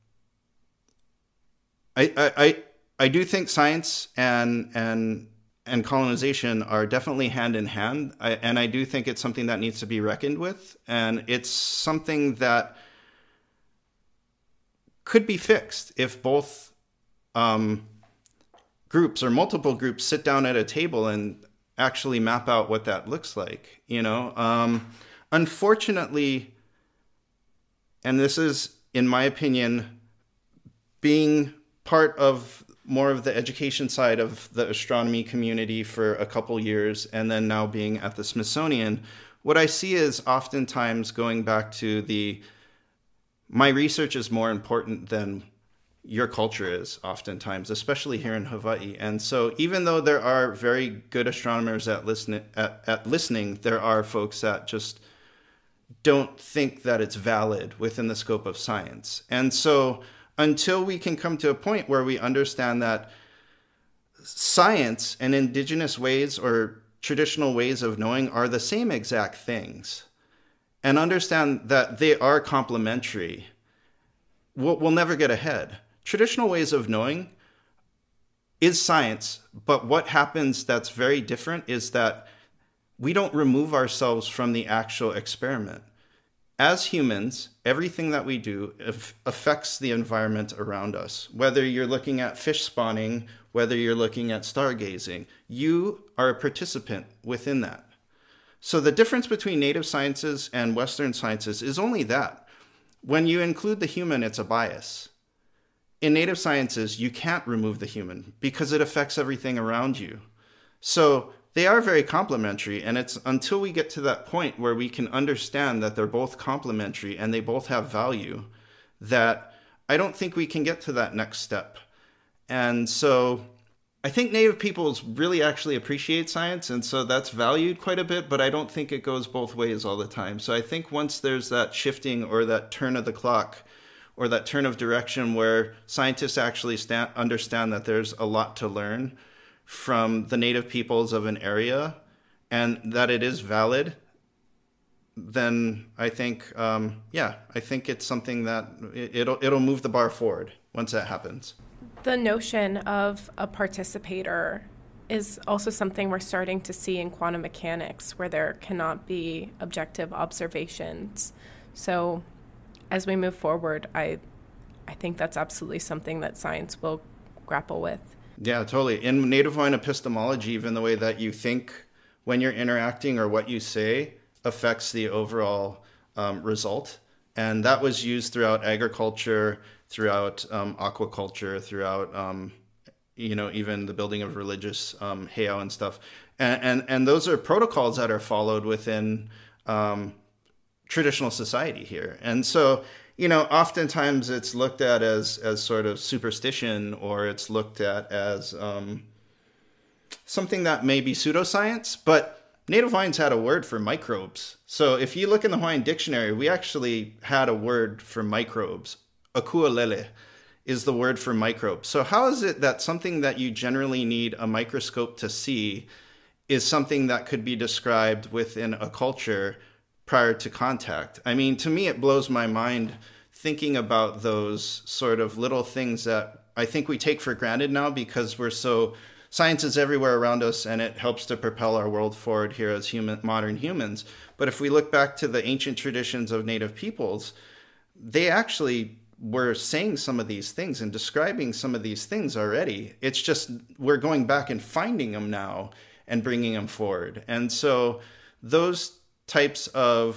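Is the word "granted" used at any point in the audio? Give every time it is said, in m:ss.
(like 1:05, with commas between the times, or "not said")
3:47.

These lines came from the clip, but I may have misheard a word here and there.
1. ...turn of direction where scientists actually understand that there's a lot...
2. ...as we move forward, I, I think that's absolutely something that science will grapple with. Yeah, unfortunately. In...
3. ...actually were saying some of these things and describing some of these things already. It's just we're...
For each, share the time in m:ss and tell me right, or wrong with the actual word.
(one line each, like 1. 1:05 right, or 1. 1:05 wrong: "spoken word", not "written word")
1. 2:14 right
2. 2:42 wrong: "totally", not "unfortunately"
3. 3:58 right.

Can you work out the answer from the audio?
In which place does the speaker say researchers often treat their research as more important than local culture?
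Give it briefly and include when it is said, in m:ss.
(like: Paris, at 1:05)
Hawaii, at 0:48.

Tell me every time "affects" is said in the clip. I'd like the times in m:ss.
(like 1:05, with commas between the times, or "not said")
1:29, 1:48, 2:54.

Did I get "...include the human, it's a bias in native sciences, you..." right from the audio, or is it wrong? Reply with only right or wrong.
right.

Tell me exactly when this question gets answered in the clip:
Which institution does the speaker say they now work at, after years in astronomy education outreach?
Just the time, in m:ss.
0:38.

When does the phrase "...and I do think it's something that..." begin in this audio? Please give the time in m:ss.
0:08.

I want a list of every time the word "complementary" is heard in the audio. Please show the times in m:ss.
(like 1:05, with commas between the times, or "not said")
1:12, 1:52, 1:56.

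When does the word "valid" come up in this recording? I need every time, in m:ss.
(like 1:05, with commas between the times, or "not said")
0:57, 2:23.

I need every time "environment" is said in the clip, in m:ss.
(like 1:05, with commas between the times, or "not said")
1:29.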